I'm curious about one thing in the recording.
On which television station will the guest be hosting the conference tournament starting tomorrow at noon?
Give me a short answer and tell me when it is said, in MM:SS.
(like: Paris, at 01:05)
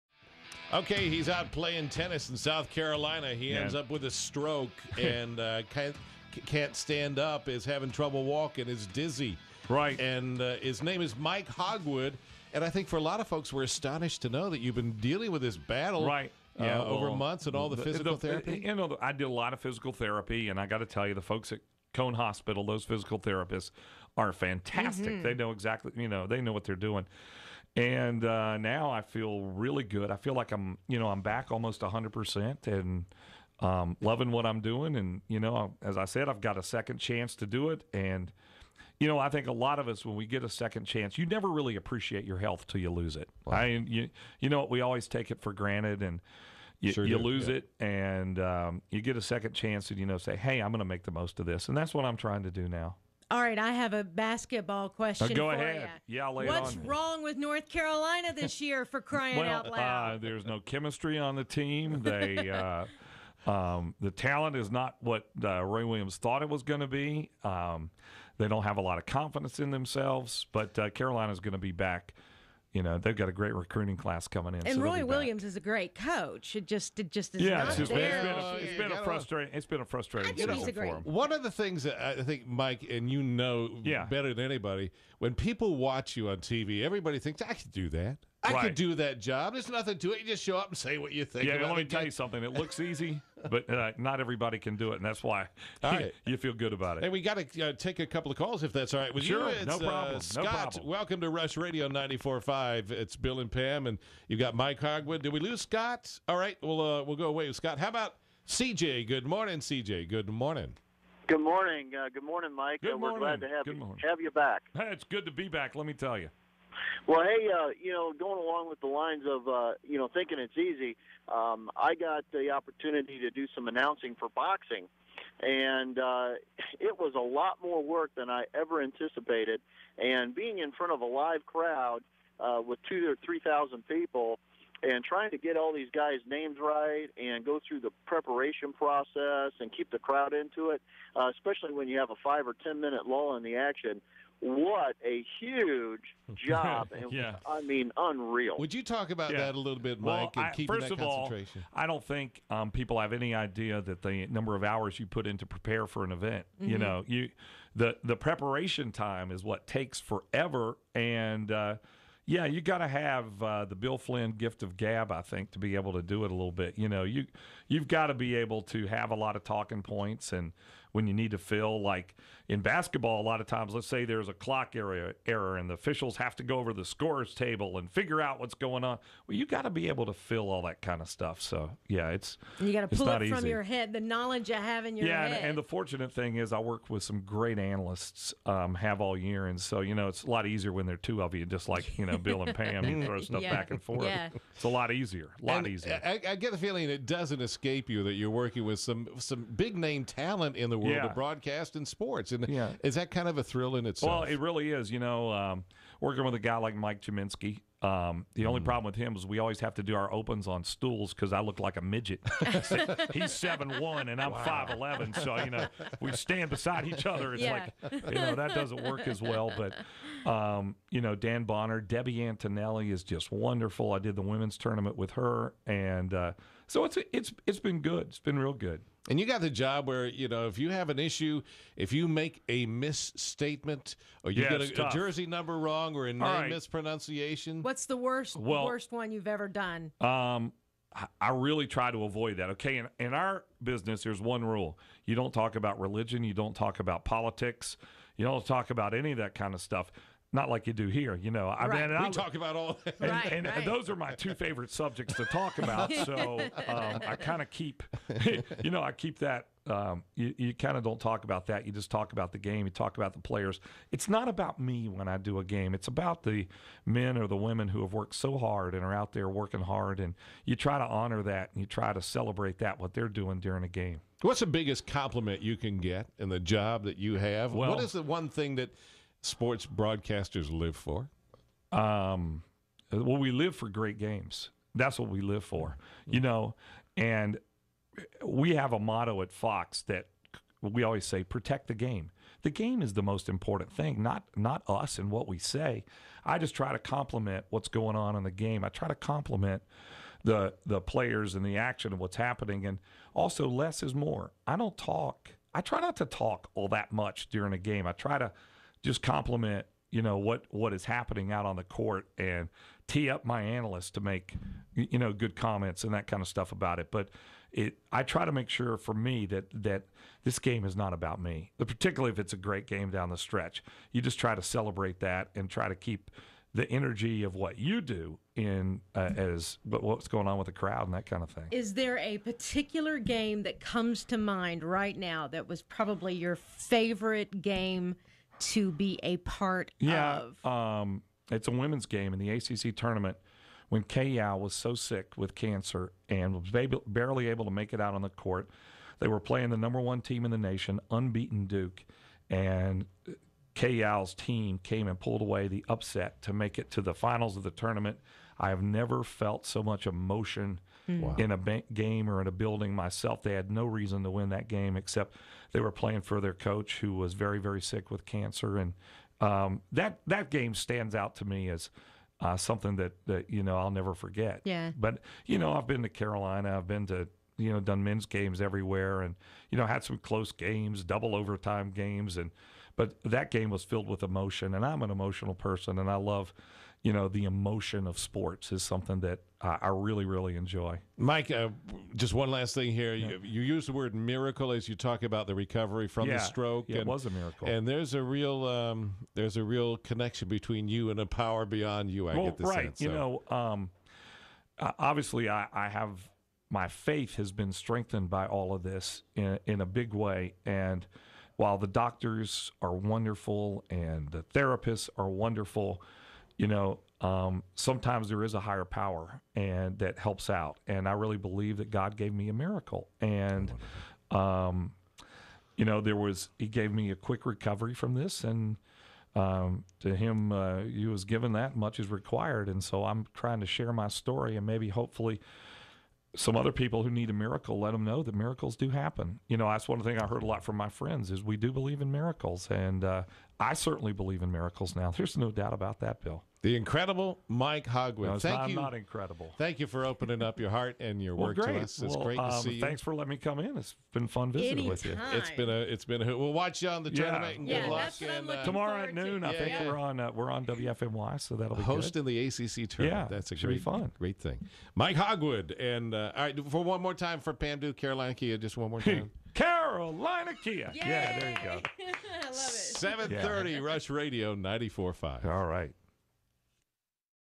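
WFMY, at 07:40.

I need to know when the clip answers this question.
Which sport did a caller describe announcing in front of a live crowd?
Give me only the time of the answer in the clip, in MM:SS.
02:04.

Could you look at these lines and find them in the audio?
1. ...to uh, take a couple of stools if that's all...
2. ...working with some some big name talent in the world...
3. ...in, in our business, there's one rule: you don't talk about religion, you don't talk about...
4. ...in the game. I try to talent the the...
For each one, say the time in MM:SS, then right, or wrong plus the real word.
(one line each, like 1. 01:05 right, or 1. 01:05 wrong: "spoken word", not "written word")
1. 01:37 wrong: "calls", not "stools"
2. 03:18 right
3. 04:02 right
4. 04:58 wrong: "compliment", not "talent".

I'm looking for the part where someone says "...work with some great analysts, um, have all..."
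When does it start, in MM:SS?
03:06.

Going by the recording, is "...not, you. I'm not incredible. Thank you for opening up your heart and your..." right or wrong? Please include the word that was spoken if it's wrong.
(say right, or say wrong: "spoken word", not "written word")
right.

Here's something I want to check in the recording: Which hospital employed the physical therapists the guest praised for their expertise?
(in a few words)
Cone Hospital.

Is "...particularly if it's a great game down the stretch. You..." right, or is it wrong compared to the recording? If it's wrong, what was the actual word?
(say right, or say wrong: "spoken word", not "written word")
right.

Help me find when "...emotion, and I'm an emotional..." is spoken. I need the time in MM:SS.
06:24.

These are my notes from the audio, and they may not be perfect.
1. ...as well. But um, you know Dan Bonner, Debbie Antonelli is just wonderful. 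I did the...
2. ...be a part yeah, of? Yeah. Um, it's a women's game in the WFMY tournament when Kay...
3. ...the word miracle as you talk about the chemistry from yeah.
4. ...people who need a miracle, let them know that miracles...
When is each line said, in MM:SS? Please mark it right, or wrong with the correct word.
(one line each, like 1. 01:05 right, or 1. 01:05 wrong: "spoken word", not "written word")
1. 03:39 right
2. 05:38 wrong: "ACC", not "WFMY"
3. 06:33 wrong: "recovery", not "chemistry"
4. 07:16 right.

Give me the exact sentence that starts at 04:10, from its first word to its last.
Not like you do here, you know.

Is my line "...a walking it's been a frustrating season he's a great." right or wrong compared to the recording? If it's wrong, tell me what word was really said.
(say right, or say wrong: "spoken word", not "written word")
wrong: "frustrating", not "walking".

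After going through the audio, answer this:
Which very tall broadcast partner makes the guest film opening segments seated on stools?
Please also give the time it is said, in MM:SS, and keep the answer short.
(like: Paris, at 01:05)
Mike Gminski, at 03:26.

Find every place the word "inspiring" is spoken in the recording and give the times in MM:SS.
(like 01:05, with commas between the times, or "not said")
not said.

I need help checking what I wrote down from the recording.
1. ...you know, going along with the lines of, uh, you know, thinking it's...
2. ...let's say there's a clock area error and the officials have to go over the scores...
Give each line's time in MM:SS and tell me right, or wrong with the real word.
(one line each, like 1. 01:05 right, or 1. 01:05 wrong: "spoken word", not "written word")
1. 01:57 right
2. 02:53 right.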